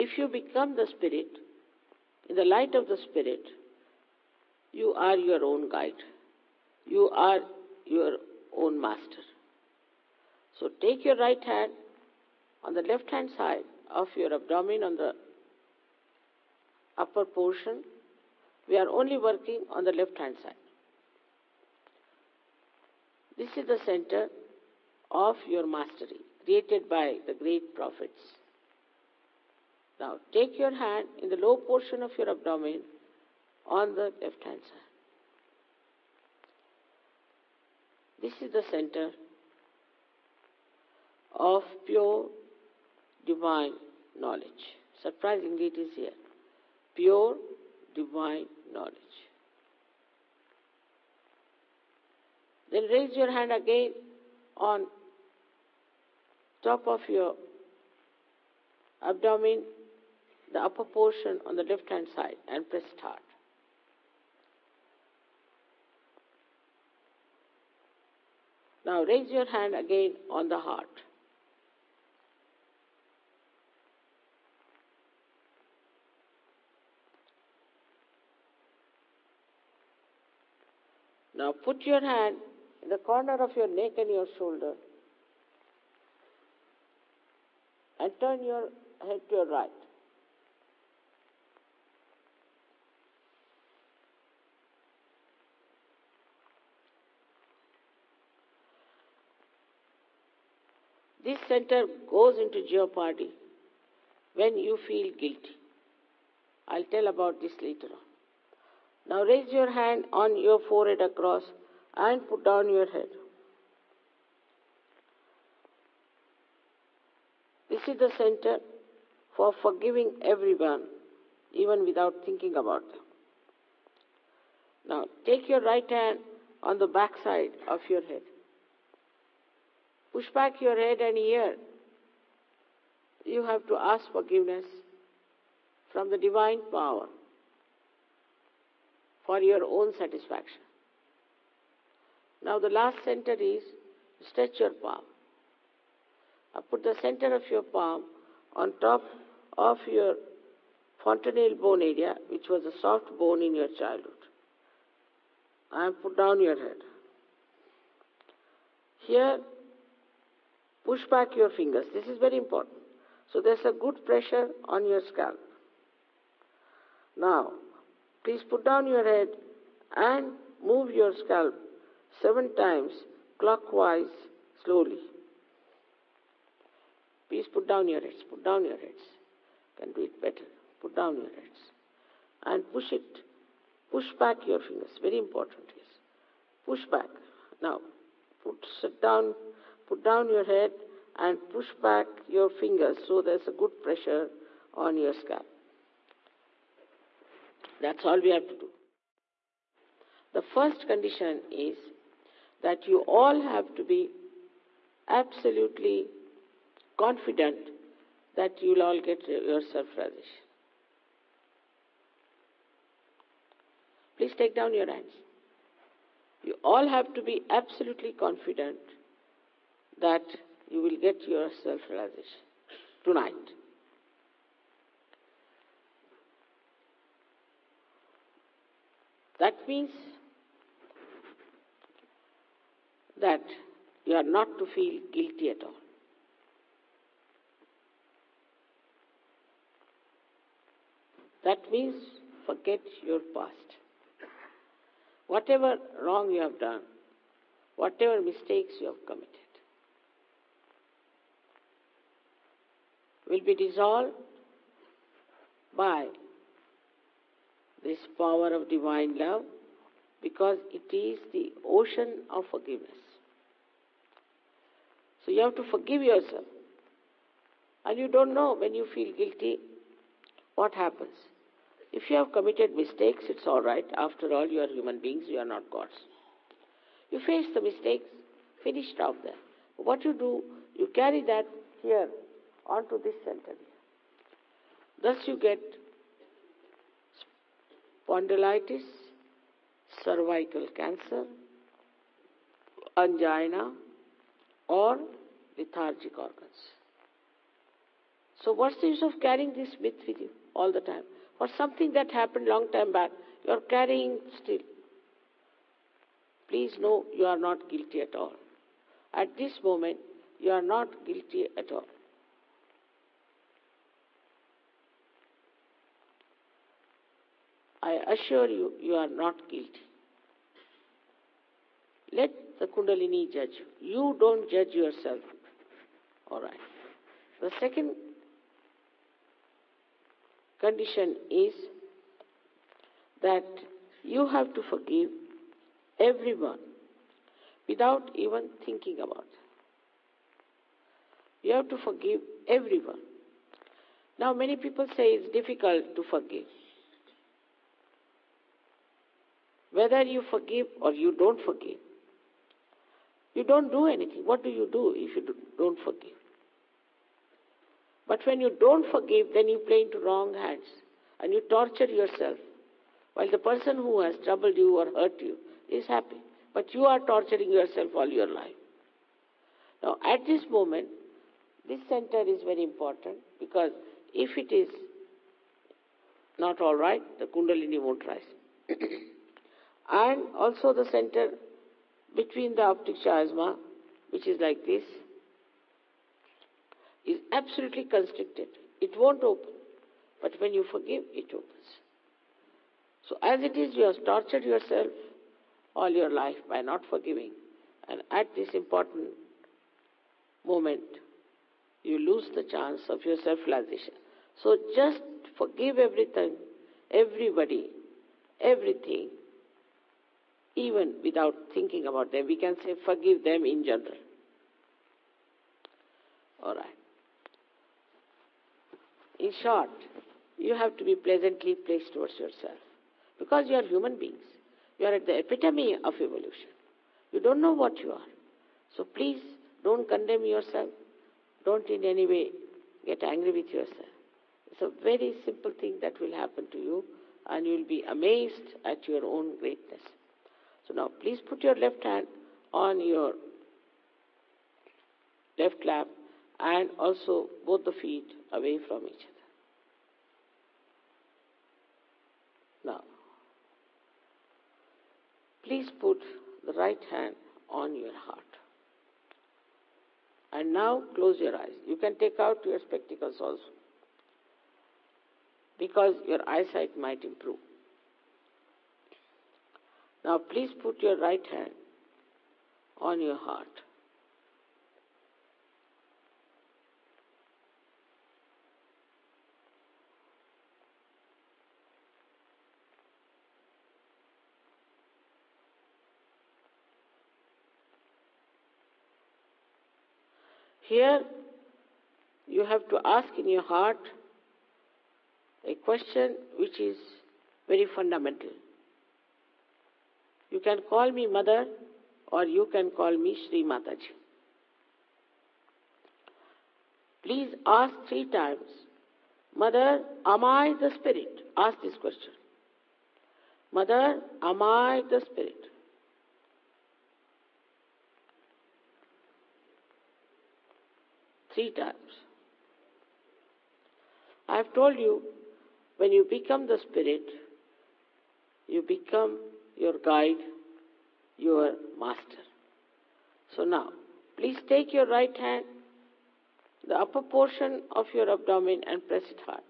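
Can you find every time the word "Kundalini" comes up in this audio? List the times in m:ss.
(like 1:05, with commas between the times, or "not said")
5:22, 6:17.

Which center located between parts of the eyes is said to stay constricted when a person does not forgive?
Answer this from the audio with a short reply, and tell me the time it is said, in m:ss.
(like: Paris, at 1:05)
optic chiasma, at 6:22.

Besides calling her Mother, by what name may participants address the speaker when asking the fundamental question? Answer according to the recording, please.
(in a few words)
Sri Mataji.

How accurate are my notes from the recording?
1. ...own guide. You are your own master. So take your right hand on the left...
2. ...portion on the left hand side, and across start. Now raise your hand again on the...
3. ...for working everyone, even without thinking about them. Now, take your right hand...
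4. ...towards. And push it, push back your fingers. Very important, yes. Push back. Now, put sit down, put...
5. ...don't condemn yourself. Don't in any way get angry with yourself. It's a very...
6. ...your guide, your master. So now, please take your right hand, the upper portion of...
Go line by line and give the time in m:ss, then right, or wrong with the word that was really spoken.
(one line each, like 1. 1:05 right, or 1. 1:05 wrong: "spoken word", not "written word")
1. 0:05 right
2. 1:00 wrong: "press", not "across"
3. 1:59 wrong: "forgiving", not "working"
4. 3:01 wrong: "heads", not "towards"
5. 7:09 right
6. 8:49 right.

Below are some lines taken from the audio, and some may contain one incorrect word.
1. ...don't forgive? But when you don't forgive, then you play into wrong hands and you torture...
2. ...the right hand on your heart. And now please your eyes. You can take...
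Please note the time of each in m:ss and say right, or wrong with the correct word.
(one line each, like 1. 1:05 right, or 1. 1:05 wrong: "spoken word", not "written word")
1. 5:55 right
2. 7:36 wrong: "close", not "please".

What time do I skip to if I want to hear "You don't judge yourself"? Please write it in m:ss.
5:23.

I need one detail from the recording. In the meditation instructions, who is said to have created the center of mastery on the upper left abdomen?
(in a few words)
the great prophets.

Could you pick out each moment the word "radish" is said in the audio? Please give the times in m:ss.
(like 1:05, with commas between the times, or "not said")
3:29, 3:41.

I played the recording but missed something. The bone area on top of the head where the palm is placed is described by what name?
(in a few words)
fontanel bone.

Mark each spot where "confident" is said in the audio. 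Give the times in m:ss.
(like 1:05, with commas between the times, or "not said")
3:26, 3:38.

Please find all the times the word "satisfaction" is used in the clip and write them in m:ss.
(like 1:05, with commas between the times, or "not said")
2:19.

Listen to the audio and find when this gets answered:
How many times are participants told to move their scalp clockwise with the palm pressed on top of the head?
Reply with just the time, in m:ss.
2:52.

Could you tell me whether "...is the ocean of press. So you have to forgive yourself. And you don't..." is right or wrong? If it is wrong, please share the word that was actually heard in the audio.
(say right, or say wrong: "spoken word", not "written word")
wrong: "forgiveness", not "press".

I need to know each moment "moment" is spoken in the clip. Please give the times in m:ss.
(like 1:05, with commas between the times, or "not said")
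5:09, 6:10, 6:40.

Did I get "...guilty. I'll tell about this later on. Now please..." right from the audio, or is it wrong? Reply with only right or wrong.
wrong.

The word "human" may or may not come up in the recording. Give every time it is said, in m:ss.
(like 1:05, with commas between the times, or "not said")
4:34, 7:03.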